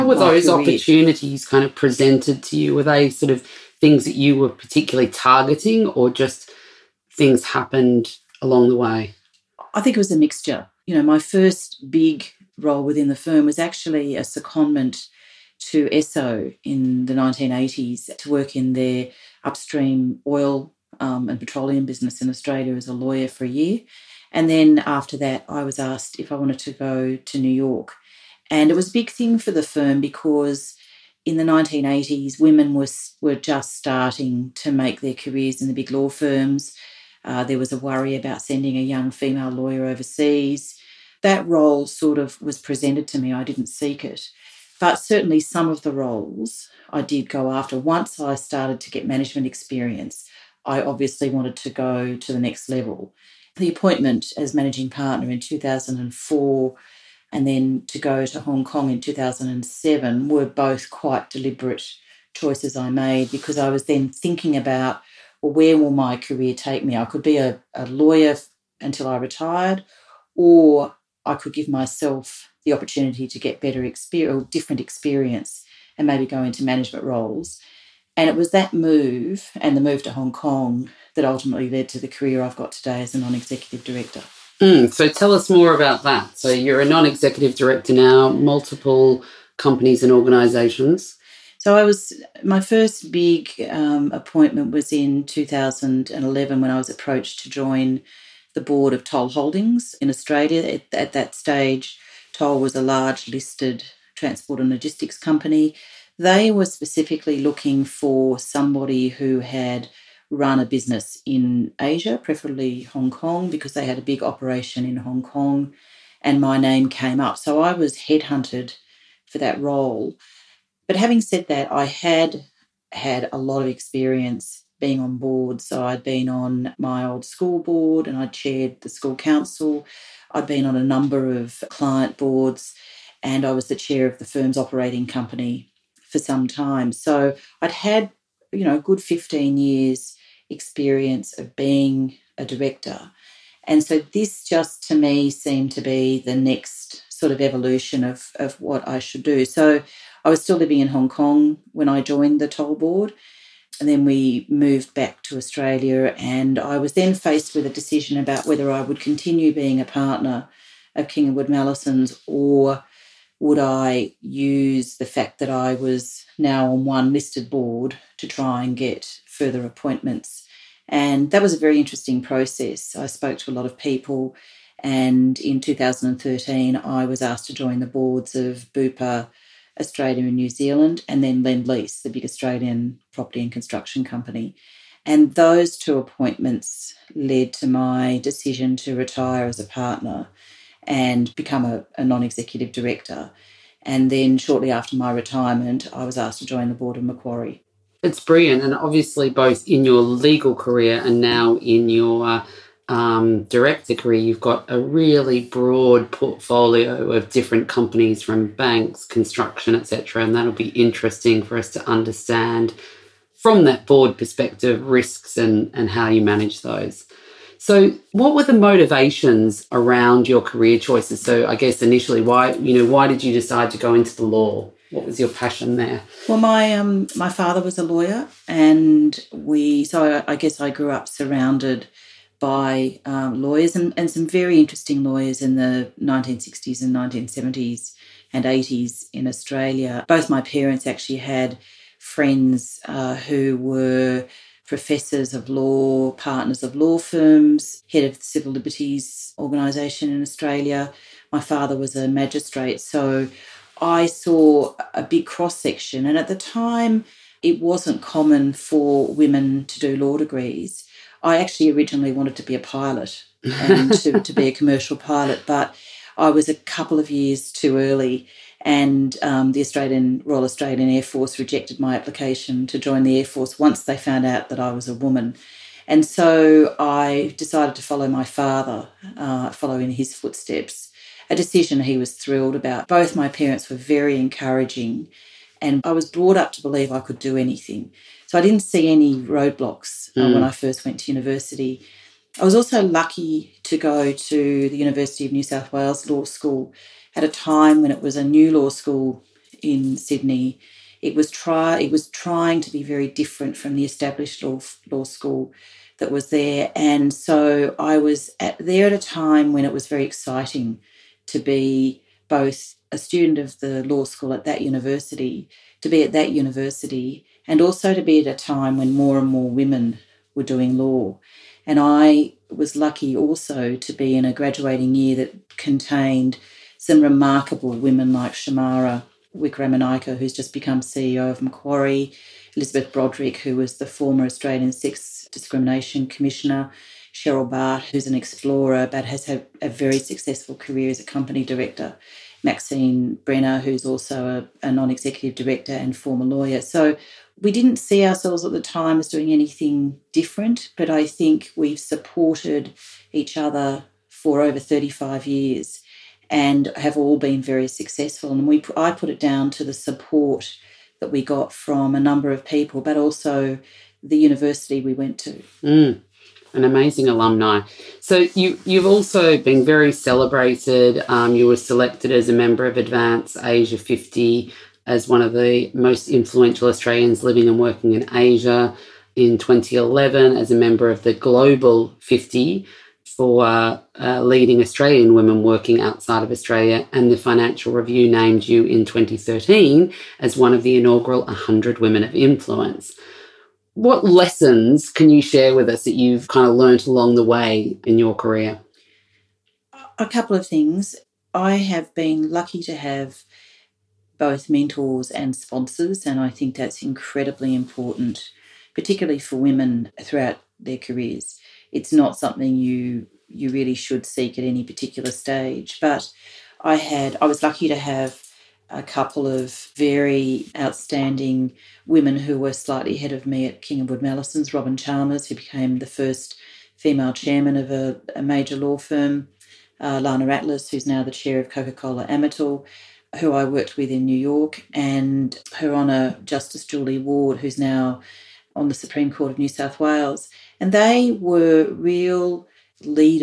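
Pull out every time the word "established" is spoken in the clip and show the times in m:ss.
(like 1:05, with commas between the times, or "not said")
5:03.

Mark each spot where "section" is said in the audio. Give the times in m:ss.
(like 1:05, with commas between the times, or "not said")
4:15.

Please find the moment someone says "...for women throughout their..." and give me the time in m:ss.
6:49.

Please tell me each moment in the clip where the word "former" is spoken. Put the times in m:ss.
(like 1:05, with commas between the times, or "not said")
5:33, 5:45.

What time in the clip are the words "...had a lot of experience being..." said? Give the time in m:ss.
2:02.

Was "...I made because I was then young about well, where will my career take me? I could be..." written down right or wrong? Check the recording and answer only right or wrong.
wrong.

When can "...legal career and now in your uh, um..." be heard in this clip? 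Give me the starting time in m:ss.
3:19.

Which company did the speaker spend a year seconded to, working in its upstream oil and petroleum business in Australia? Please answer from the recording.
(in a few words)
Esso.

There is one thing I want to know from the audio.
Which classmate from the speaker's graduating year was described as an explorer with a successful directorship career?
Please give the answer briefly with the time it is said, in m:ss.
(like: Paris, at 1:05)
Cheryl Bart, at 5:37.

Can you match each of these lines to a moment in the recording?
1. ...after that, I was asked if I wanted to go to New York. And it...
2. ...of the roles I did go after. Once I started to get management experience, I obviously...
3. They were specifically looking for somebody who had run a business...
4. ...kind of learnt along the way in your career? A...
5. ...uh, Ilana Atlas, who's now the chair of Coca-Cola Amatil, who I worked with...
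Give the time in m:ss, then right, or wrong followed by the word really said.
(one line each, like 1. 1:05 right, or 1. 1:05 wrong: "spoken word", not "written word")
1. 0:24 right
2. 0:45 right
3. 1:46 right
4. 6:36 right
5. 7:09 right.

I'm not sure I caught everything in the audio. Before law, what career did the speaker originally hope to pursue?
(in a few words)
Commercial pilot.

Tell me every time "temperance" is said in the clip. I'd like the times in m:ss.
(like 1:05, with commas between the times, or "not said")
not said.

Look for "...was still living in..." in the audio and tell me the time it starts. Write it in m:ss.
2:30.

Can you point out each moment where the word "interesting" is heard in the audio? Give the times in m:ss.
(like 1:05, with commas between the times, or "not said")
2:51, 3:30, 3:54.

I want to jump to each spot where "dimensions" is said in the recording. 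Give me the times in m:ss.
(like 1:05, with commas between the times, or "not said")
not said.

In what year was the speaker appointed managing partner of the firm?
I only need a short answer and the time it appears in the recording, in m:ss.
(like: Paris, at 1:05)
2004, at 0:55.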